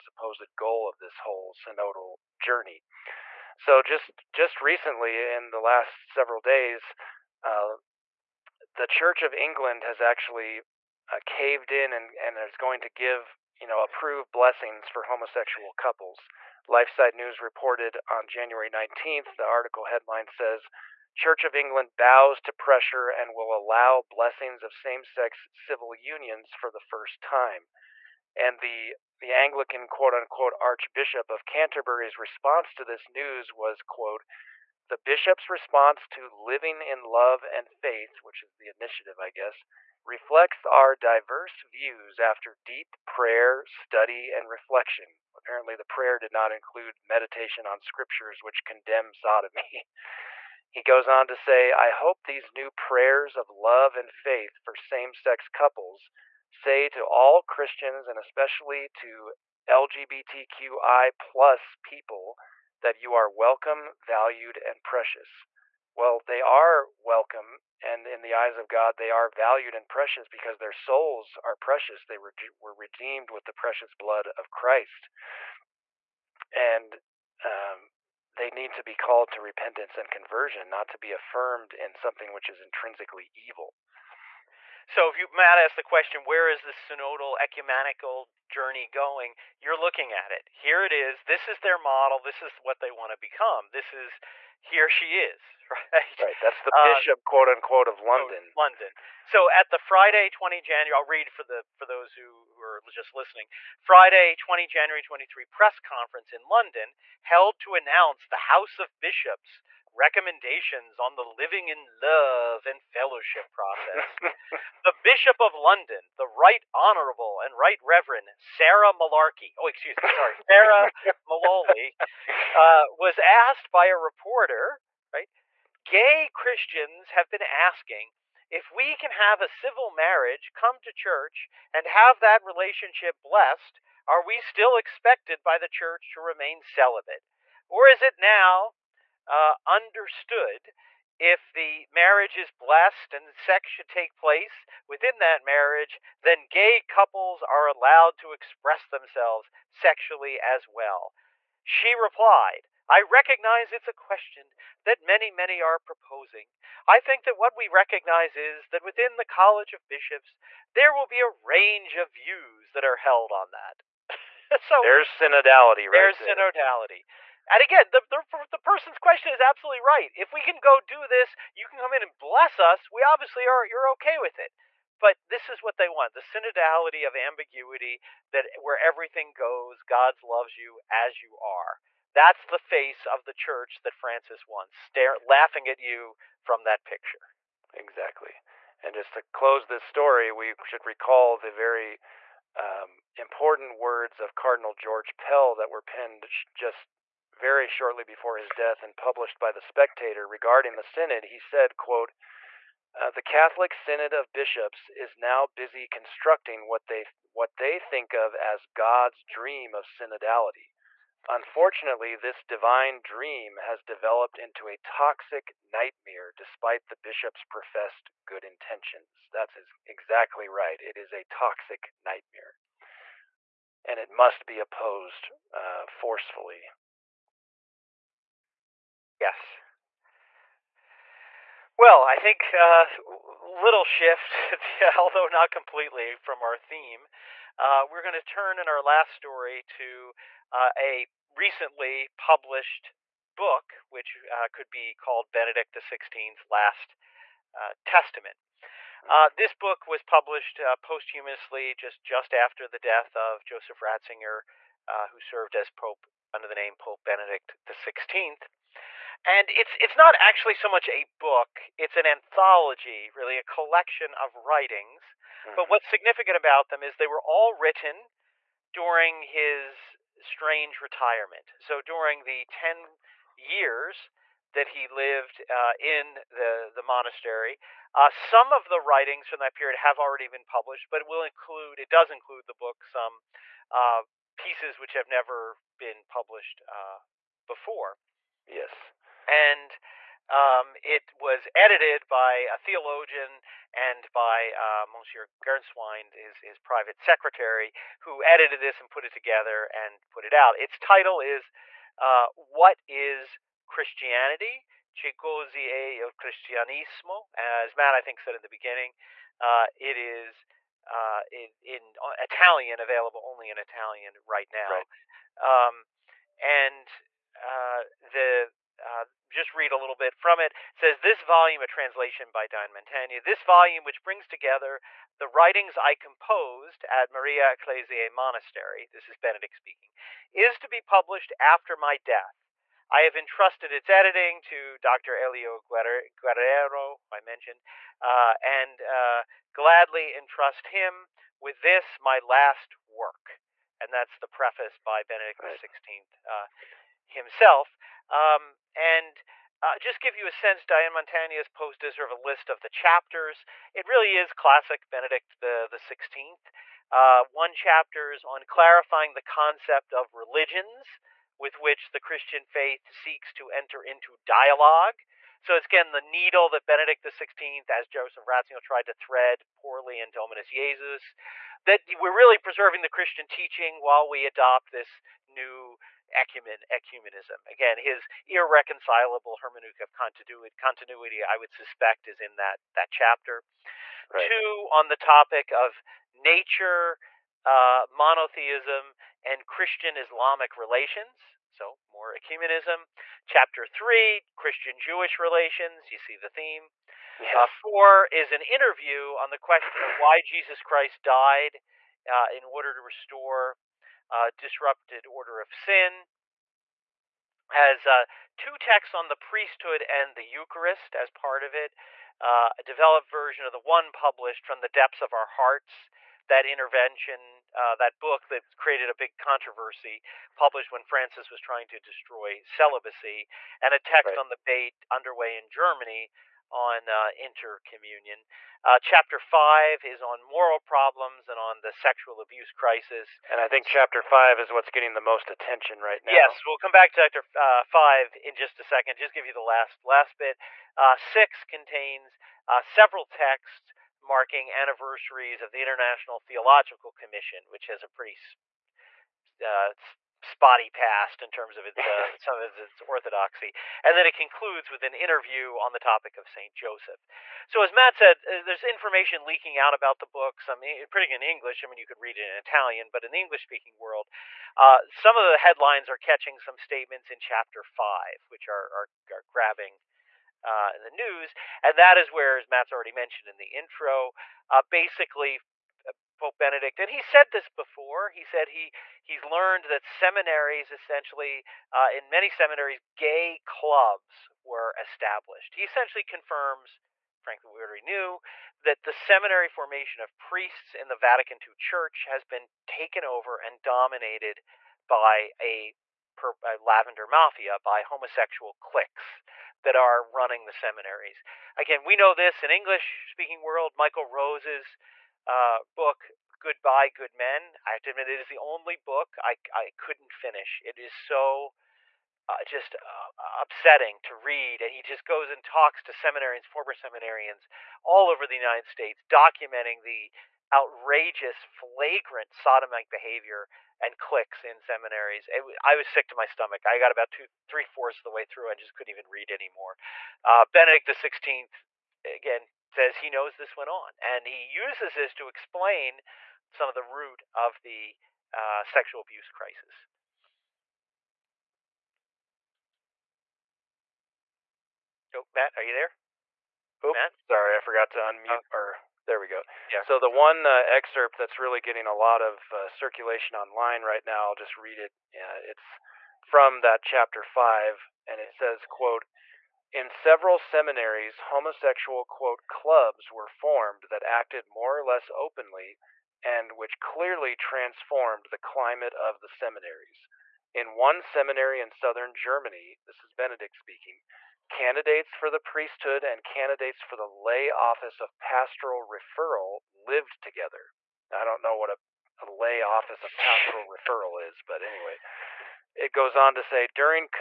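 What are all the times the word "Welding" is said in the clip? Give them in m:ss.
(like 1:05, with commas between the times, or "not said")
not said.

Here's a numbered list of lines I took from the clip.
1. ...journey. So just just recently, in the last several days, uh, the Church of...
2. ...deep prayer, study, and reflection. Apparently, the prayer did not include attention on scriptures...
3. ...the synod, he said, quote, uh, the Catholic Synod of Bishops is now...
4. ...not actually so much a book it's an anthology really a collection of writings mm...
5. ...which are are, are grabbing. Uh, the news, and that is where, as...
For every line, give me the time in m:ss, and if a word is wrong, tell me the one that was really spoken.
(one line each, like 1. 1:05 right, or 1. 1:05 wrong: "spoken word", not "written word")
1. 0:02 right
2. 0:42 wrong: "meditation", not "attention"
3. 3:20 right
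4. 4:19 right
5. 7:48 right.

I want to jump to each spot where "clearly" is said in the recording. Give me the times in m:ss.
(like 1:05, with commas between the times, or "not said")
9:26.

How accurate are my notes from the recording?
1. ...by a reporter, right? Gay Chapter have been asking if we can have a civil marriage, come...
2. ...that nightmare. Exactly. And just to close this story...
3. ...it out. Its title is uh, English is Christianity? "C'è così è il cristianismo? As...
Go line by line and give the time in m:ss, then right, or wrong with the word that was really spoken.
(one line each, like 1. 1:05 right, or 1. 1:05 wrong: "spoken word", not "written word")
1. 2:03 wrong: "Christians", not "Chapter"
2. 3:06 wrong: "picture", not "nightmare"
3. 5:00 wrong: "What", not "English".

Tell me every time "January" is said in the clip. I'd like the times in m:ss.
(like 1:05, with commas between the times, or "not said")
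0:18, 1:40, 1:44.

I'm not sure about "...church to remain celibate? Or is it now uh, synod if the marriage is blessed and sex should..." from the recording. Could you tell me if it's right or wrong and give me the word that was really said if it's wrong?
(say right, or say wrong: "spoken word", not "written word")
wrong: "understood", not "synod".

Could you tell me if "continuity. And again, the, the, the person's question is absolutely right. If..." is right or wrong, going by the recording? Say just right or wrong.
wrong.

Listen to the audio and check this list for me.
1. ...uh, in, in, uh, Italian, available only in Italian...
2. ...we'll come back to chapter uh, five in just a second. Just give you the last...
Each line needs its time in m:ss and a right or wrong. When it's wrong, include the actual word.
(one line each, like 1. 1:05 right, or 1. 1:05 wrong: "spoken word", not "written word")
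1. 5:10 right
2. 7:16 right.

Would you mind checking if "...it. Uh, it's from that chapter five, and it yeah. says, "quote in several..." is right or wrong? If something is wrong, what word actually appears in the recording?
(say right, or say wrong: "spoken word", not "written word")
right.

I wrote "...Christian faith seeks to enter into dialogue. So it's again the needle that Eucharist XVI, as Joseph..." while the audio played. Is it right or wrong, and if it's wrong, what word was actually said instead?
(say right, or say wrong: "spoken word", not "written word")
wrong: "Benedict", not "Eucharist".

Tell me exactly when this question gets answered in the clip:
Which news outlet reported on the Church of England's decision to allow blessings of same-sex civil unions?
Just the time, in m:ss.
0:16.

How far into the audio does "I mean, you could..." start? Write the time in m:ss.
7:41.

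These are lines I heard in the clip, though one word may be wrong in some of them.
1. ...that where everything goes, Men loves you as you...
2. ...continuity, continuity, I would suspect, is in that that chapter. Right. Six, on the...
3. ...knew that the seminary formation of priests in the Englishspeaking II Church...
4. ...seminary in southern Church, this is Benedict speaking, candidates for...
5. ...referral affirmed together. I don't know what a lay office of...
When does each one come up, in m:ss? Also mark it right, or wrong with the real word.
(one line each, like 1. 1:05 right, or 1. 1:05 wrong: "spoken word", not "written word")
1. 2:58 wrong: "God", not "Men"
2. 6:19 wrong: "Two", not "Six"
3. 8:07 wrong: "Vatican", not "Englishspeaking"
4. 9:31 wrong: "Germany", not "Church"
5. 9:38 wrong: "lived", not "affirmed".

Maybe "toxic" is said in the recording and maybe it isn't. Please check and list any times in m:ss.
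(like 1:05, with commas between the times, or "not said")
3:34, 3:41.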